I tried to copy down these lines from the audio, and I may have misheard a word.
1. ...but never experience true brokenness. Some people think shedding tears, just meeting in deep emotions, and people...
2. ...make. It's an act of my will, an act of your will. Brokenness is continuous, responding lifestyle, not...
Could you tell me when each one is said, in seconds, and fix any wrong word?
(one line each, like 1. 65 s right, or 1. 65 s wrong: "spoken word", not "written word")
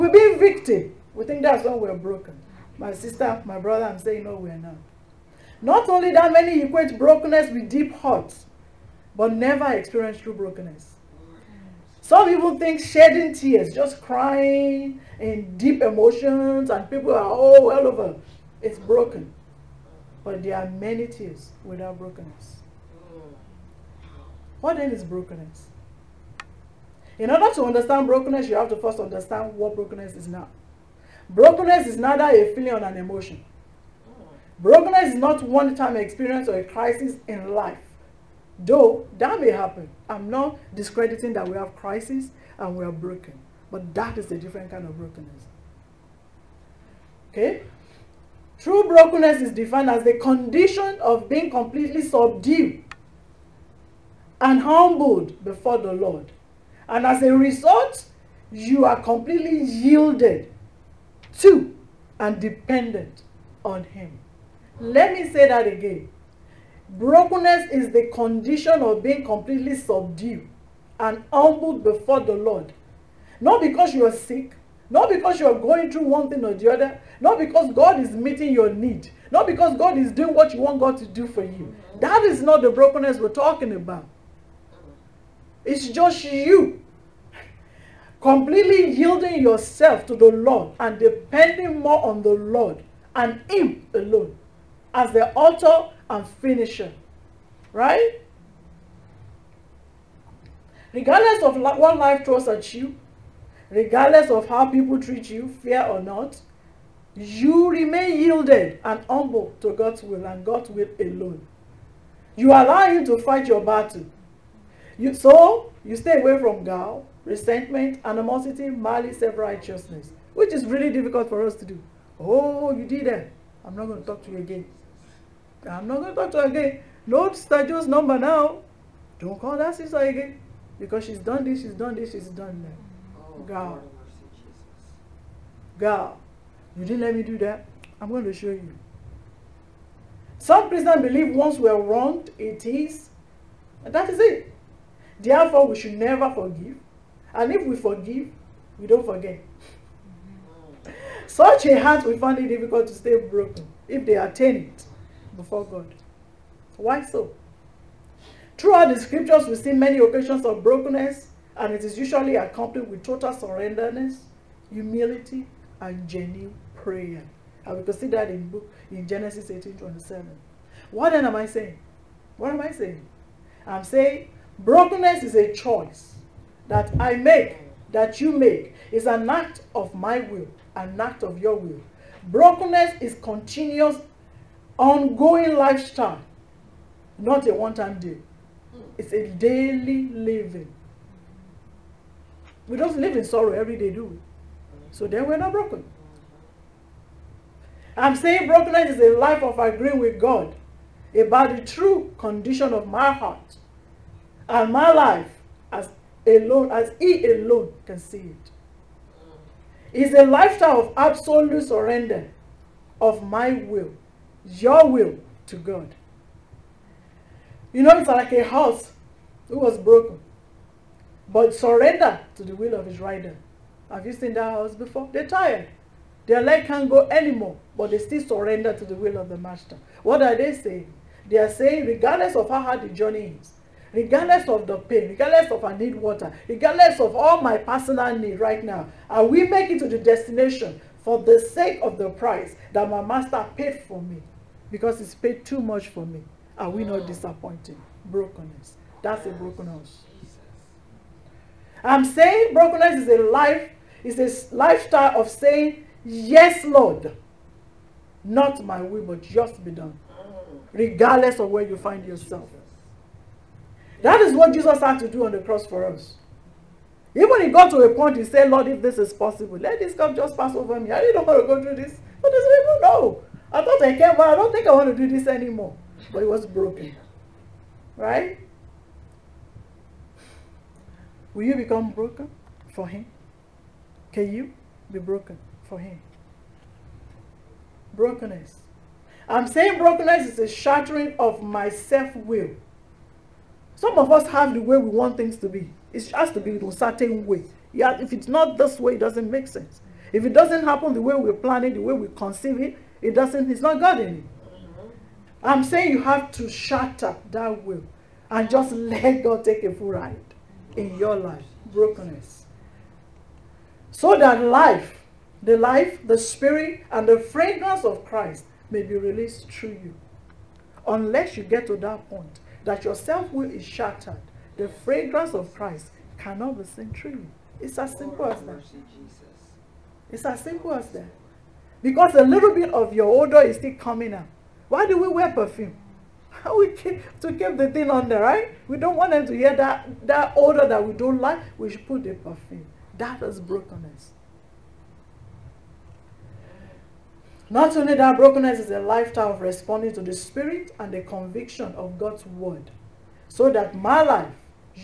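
1. 9 s wrong: "crying", not "meeting"
2. 178 s wrong: "ongoing", not "responding".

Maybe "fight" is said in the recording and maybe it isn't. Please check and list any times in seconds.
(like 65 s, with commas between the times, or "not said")
113 s.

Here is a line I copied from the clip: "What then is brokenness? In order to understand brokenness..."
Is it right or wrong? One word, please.
right.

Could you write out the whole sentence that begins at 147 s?
And if we forgive, we don't forget.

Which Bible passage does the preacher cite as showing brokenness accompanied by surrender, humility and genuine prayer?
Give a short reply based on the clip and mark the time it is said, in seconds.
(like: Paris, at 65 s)
Genesis 18:27, at 169 s.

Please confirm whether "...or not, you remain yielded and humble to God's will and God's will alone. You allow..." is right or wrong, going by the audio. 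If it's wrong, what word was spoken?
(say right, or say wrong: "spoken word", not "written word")
right.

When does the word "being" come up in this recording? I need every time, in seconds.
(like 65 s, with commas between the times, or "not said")
51 s, 69 s.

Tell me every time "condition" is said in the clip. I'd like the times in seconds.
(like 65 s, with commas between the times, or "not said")
50 s, 68 s, 202 s.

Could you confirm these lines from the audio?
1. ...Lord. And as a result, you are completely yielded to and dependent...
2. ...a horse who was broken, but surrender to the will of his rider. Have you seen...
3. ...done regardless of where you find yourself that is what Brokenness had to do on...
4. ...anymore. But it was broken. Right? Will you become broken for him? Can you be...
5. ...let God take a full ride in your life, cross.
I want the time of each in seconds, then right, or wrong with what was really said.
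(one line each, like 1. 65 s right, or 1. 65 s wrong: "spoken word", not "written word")
1. 55 s right
2. 218 s right
3. 259 s wrong: "Jesus", not "Brokenness"
4. 275 s right
5. 308 s wrong: "brokenness", not "cross".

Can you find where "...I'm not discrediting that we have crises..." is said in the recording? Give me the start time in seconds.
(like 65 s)
40 s.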